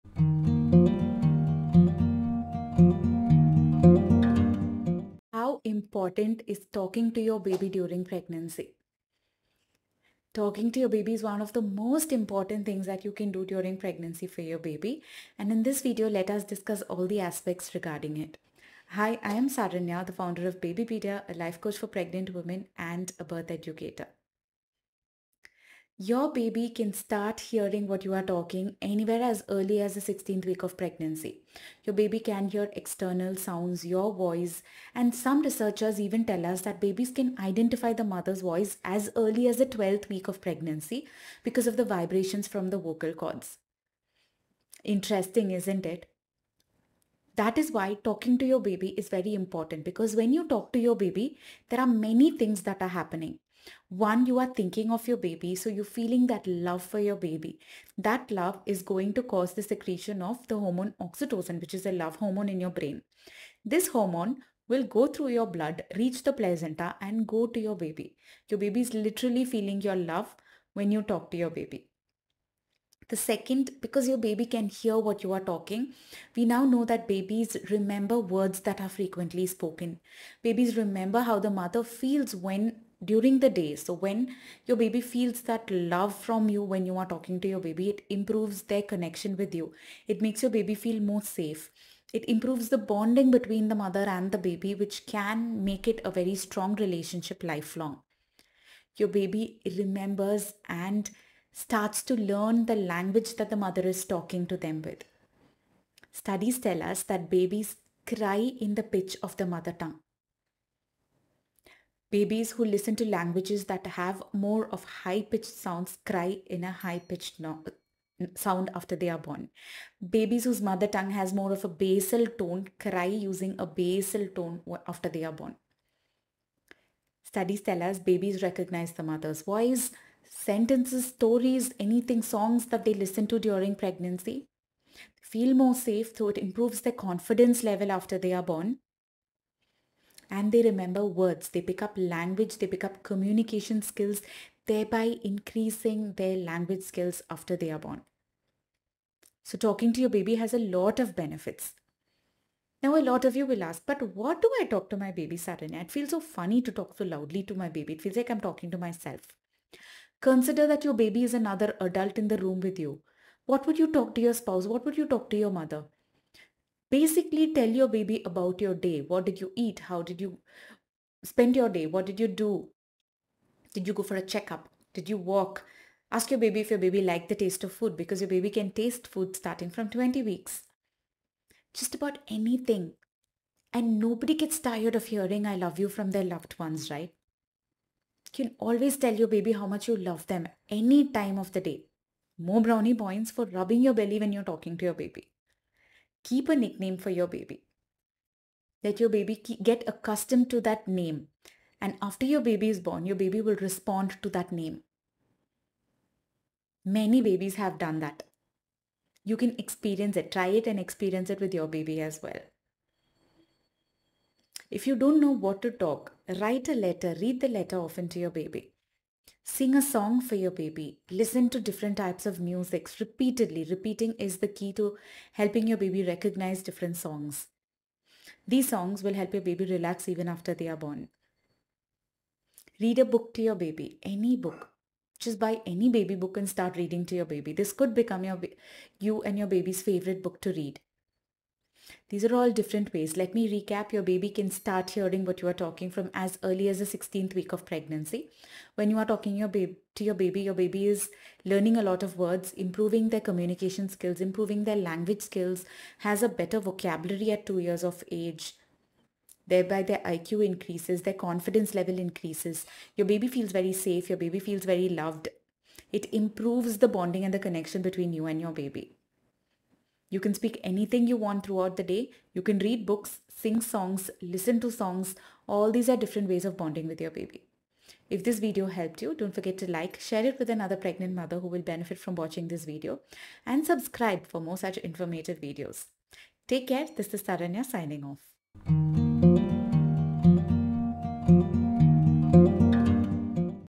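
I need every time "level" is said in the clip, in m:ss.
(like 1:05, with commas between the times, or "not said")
2:17, 4:21.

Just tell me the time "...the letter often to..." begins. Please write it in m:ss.
3:37.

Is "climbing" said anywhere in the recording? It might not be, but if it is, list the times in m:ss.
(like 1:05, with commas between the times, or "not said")
not said.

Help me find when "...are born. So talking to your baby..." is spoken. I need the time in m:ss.
2:27.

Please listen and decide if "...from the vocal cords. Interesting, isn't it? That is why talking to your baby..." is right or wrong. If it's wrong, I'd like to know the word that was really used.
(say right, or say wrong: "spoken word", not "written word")
right.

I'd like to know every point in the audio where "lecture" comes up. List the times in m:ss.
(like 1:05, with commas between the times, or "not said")
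not said.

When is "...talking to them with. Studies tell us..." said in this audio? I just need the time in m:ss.
1:44.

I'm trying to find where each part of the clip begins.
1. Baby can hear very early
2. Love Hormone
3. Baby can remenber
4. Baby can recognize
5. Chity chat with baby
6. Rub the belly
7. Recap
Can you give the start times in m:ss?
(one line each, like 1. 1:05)
1. 0:30
2. 1:00
3. 1:21
4. 2:08
5. 2:48
6. 3:13
7. 4:03.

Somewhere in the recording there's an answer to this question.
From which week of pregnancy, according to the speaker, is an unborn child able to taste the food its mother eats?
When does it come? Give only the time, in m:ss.
2:59.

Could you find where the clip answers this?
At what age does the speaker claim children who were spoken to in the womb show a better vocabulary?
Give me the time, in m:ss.
4:17.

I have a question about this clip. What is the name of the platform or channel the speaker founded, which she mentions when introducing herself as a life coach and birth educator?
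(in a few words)
Babypedia.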